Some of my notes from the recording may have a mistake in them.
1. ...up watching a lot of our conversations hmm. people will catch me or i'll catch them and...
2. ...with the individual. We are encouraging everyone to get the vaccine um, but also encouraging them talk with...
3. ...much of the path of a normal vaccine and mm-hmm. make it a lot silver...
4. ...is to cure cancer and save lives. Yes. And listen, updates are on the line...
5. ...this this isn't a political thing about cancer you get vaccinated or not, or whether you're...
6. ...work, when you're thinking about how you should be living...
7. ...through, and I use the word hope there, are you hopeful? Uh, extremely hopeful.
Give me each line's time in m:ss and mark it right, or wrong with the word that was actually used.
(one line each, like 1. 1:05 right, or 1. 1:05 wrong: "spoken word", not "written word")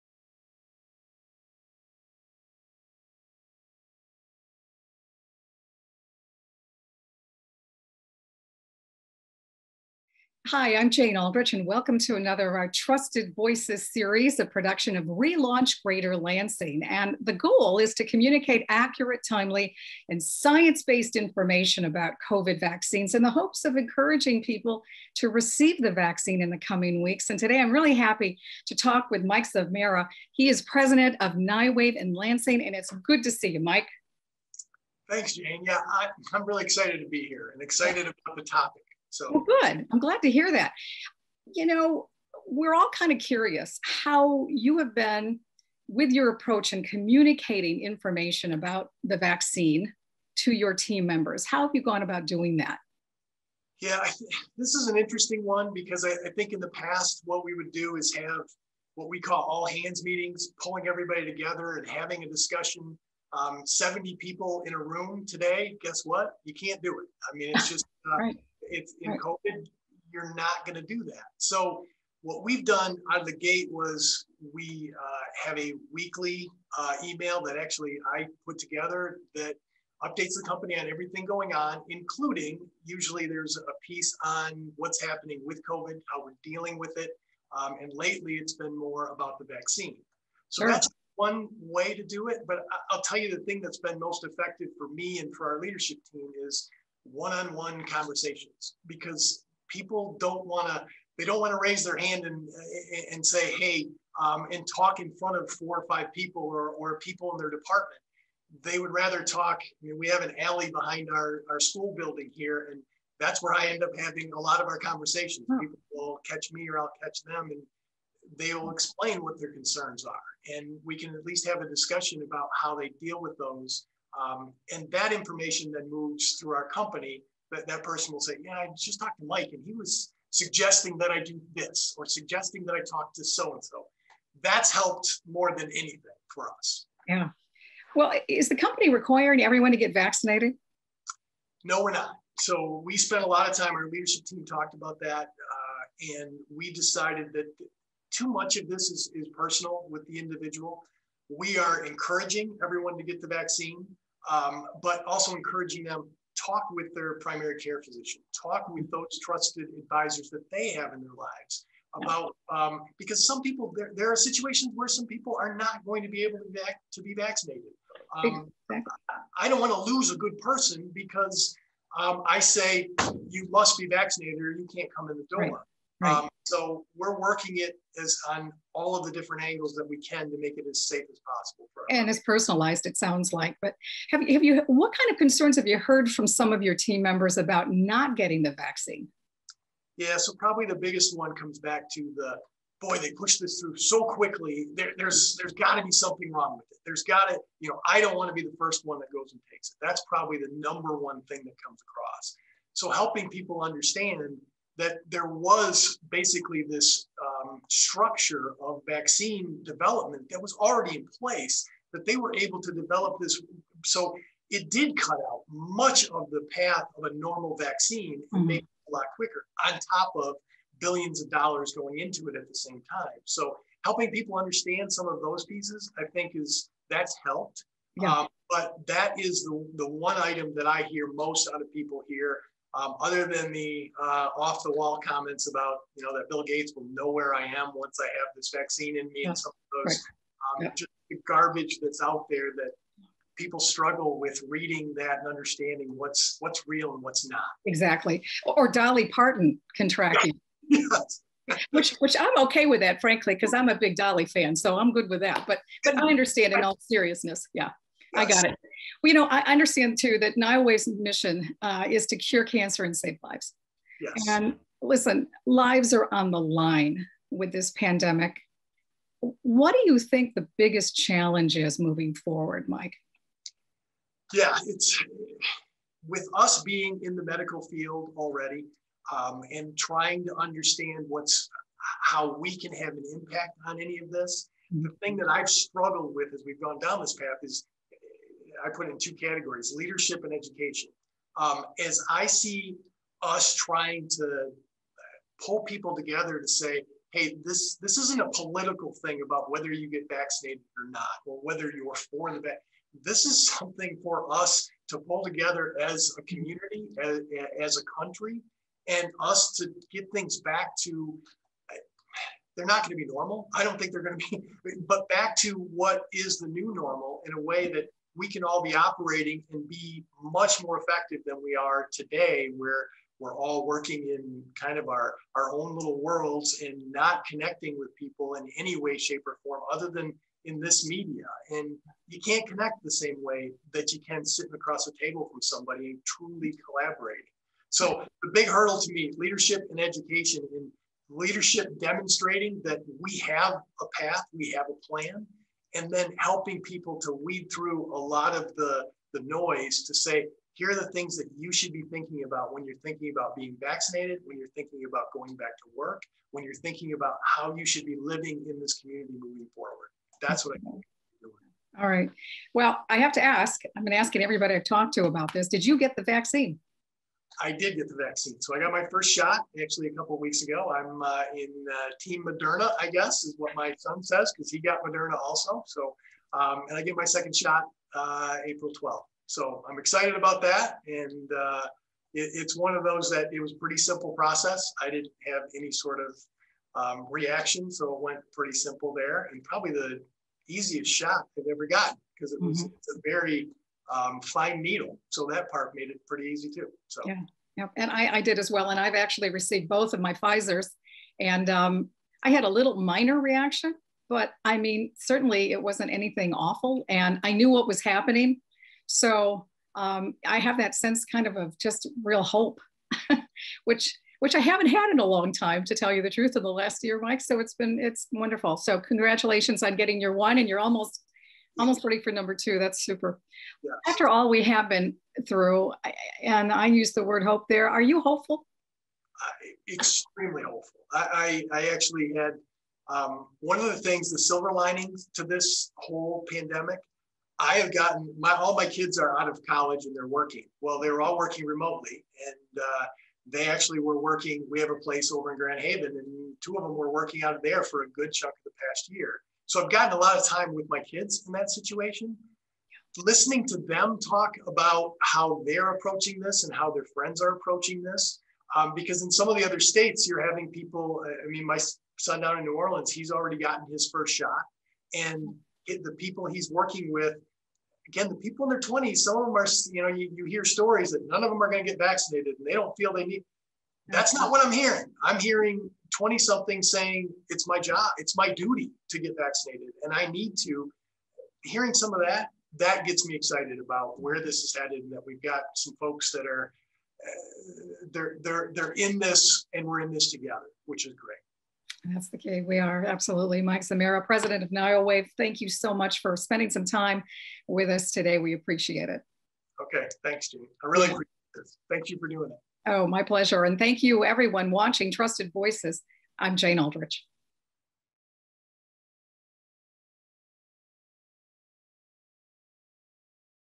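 1. 1:53 wrong: "having", not "watching"
2. 2:29 right
3. 3:35 wrong: "quicker", not "silver"
4. 4:21 wrong: "lives", not "updates"
5. 4:57 wrong: "whether", not "cancer"
6. 5:55 right
7. 7:05 right.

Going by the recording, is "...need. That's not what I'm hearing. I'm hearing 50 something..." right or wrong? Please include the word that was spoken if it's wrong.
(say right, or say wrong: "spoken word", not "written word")
wrong: "20", not "50".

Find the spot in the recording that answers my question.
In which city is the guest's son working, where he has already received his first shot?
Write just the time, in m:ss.
7:42.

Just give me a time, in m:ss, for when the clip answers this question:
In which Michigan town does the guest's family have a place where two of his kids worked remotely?
7:25.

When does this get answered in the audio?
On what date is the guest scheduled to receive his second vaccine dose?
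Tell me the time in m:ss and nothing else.
6:18.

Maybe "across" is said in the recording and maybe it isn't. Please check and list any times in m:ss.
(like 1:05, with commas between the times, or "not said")
3:21, 5:34.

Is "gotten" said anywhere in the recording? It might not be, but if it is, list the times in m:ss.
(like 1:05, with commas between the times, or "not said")
6:31, 7:17, 7:29, 7:43.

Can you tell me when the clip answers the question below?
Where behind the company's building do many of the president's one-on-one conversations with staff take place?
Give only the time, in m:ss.
1:50.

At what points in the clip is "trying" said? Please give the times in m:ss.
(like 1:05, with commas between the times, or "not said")
4:39, 4:53.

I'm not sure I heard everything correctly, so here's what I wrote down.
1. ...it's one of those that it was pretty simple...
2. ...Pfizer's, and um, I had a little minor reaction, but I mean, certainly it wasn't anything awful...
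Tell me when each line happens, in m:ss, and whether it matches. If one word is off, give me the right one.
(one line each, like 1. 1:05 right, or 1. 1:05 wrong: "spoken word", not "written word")
1. 6:22 right
2. 6:40 right.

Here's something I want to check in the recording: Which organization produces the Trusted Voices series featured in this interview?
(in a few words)
Relaunch Greater Lansing.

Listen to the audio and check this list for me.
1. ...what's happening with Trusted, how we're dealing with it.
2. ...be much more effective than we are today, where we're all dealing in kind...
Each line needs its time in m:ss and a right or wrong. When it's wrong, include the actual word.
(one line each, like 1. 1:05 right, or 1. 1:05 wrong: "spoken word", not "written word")
1. 1:24 wrong: "COVID", not "Trusted"
2. 5:19 wrong: "working", not "dealing".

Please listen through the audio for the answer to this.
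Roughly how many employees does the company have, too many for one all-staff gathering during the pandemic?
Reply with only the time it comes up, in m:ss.
1:03.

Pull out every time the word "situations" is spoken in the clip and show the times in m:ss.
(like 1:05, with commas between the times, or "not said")
2:44, 7:31.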